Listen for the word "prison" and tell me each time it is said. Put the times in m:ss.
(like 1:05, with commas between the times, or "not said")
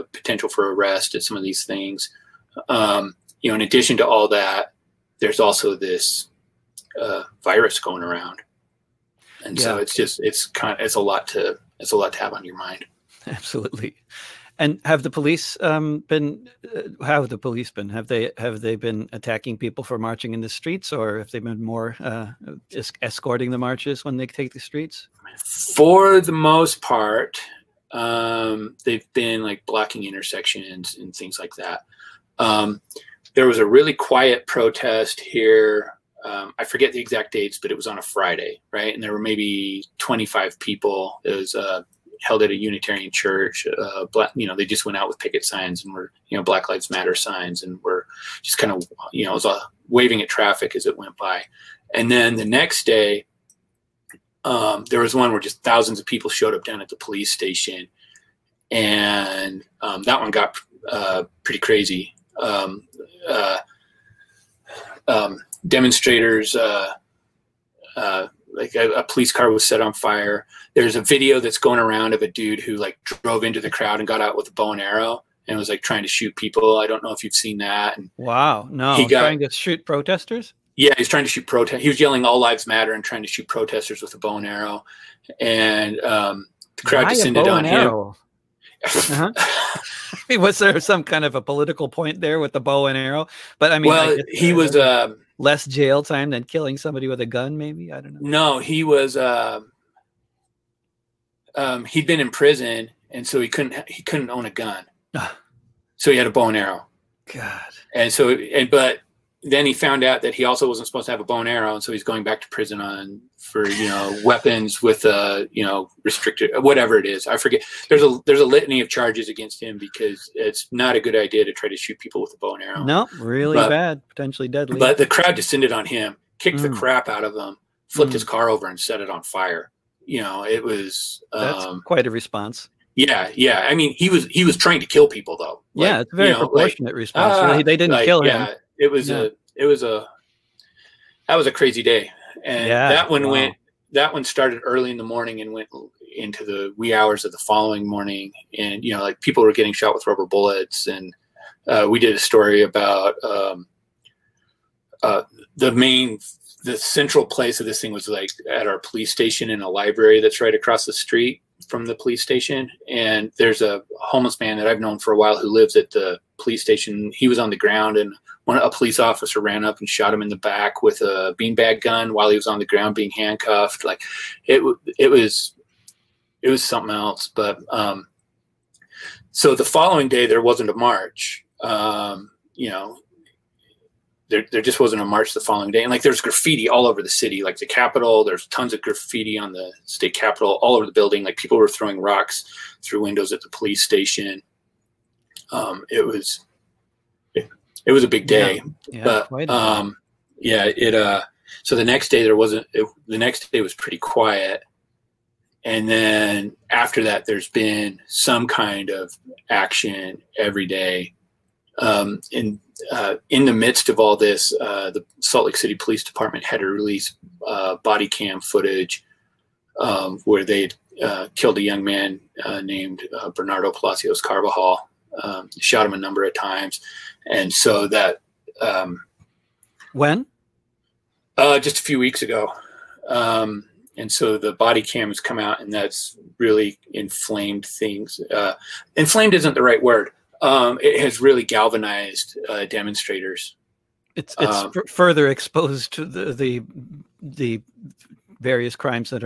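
1:42, 1:52.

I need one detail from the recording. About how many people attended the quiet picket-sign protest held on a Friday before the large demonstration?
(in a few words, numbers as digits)
25.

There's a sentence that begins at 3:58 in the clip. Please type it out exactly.
Uh, inflamed isn't the right word.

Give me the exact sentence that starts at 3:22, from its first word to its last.
It, the next day was pretty quiet, and then after that, there's been some kind of action every day.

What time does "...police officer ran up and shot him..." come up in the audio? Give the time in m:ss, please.
2:48.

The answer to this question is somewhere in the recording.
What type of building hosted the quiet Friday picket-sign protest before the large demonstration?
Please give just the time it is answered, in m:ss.
0:42.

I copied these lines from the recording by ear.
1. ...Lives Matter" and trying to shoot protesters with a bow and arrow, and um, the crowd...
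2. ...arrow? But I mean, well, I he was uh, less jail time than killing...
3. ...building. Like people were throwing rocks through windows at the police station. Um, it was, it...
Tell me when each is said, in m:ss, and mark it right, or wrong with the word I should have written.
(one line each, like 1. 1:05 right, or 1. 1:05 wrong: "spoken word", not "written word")
1. 1:22 right
2. 1:32 right
3. 3:10 right.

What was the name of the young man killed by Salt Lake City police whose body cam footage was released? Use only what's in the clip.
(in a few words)
Bernardo Palacios Carvajal.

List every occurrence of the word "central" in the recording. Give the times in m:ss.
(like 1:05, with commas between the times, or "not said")
2:36.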